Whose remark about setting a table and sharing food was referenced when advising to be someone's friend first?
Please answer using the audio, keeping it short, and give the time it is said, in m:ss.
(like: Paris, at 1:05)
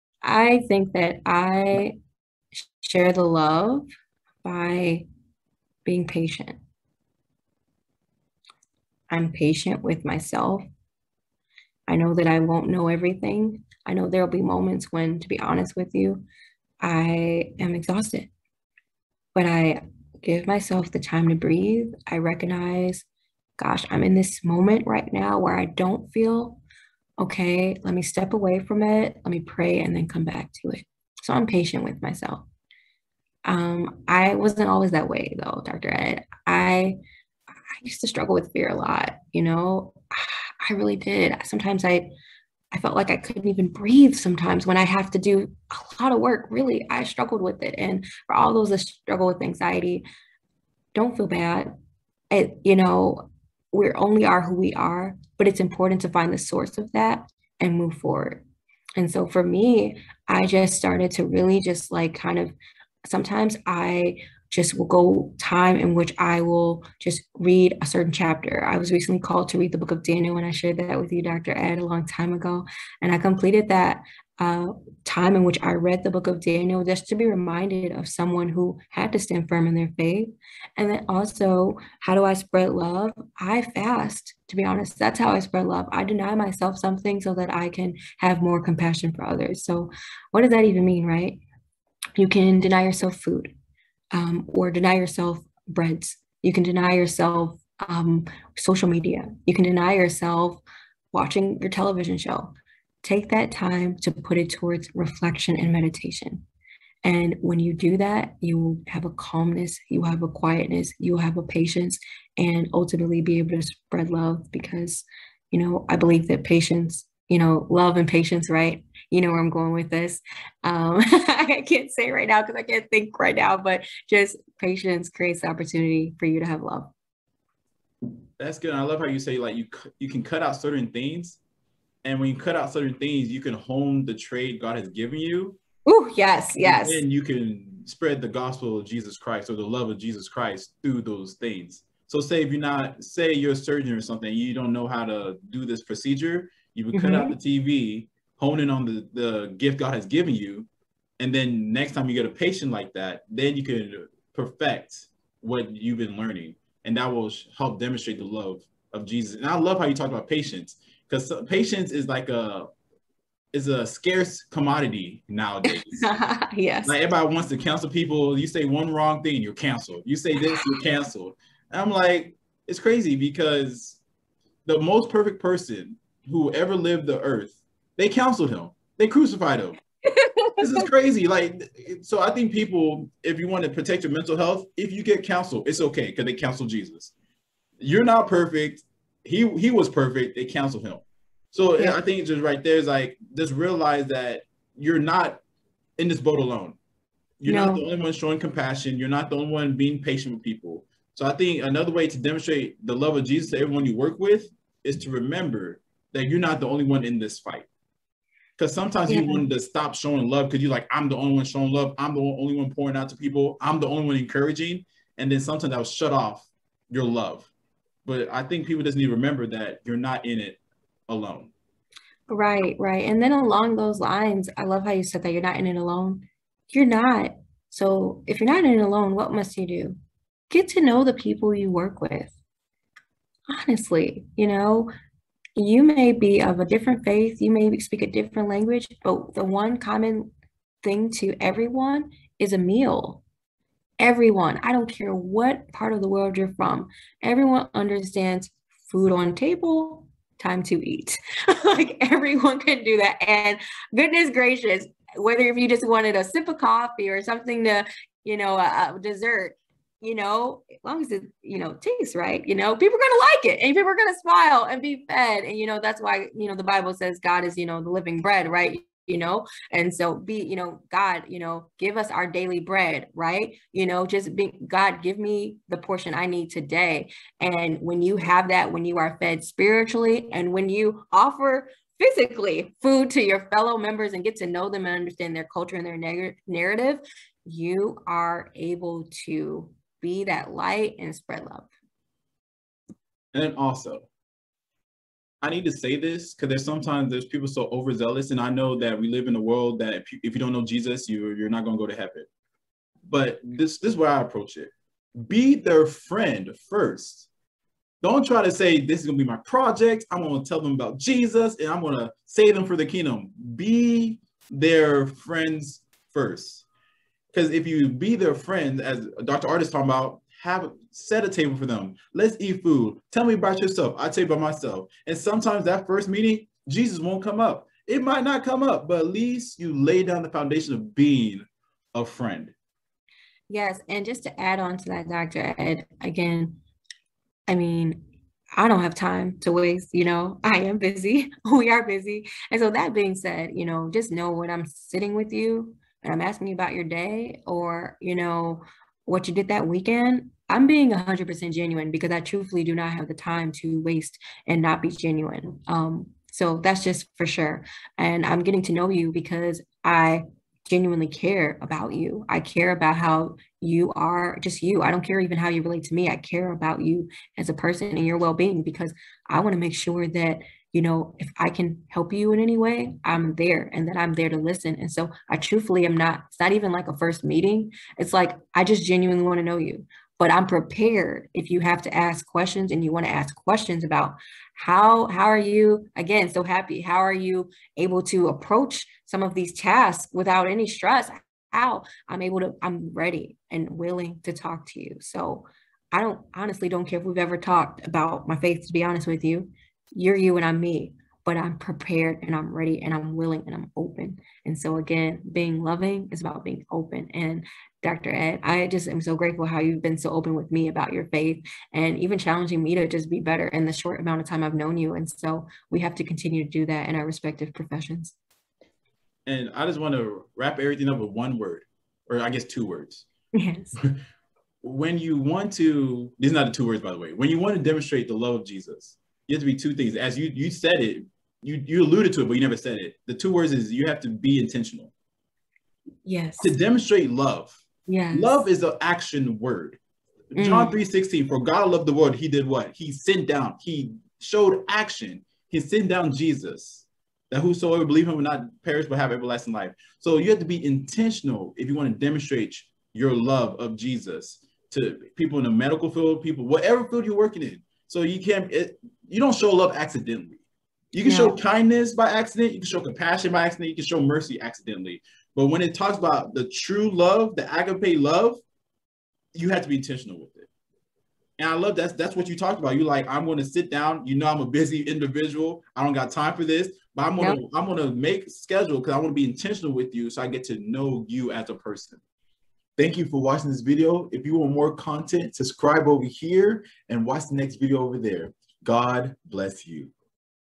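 Dr. Artis, at 5:19.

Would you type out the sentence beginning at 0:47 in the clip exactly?
And for all those that struggle with anxiety, don't feel bad.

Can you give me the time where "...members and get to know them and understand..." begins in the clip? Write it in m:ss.
4:43.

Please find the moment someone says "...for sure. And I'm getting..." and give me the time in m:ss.
5:57.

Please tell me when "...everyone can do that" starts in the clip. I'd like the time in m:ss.
4:12.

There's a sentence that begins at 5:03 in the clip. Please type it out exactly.
But this this is where I approach it: be their friend first.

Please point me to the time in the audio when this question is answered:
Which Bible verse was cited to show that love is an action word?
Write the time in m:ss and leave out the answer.
7:20.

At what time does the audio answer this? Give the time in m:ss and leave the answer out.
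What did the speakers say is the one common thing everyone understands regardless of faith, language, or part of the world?
4:02.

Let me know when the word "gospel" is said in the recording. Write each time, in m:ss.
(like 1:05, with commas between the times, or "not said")
2:18.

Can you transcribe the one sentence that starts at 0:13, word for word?
I know there'll be moments when, to be honest with you, I am exhausted.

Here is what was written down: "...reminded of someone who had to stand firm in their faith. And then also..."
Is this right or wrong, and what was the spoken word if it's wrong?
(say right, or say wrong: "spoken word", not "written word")
right.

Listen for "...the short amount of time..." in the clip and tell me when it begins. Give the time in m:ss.
6:53.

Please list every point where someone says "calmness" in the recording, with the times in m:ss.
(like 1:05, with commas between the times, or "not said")
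1:49.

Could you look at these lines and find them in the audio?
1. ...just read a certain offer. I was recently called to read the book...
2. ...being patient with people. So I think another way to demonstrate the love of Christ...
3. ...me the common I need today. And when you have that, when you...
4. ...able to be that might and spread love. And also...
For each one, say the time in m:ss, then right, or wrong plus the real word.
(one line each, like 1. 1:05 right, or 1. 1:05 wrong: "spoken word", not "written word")
1. 1:06 wrong: "chapter", not "offer"
2. 3:19 wrong: "Jesus", not "Christ"
3. 4:35 wrong: "portion", not "common"
4. 4:48 wrong: "light", not "might".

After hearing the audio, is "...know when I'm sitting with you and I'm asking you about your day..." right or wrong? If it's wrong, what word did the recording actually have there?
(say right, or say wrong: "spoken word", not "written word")
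right.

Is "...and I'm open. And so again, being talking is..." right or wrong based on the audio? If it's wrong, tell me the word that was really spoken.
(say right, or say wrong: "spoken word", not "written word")
wrong: "loving", not "talking".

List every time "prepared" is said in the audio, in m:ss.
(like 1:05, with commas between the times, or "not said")
6:20, 6:41.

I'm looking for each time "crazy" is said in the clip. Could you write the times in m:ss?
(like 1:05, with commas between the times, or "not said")
2:52, 3:00.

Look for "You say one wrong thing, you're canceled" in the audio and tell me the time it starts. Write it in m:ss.
2:48.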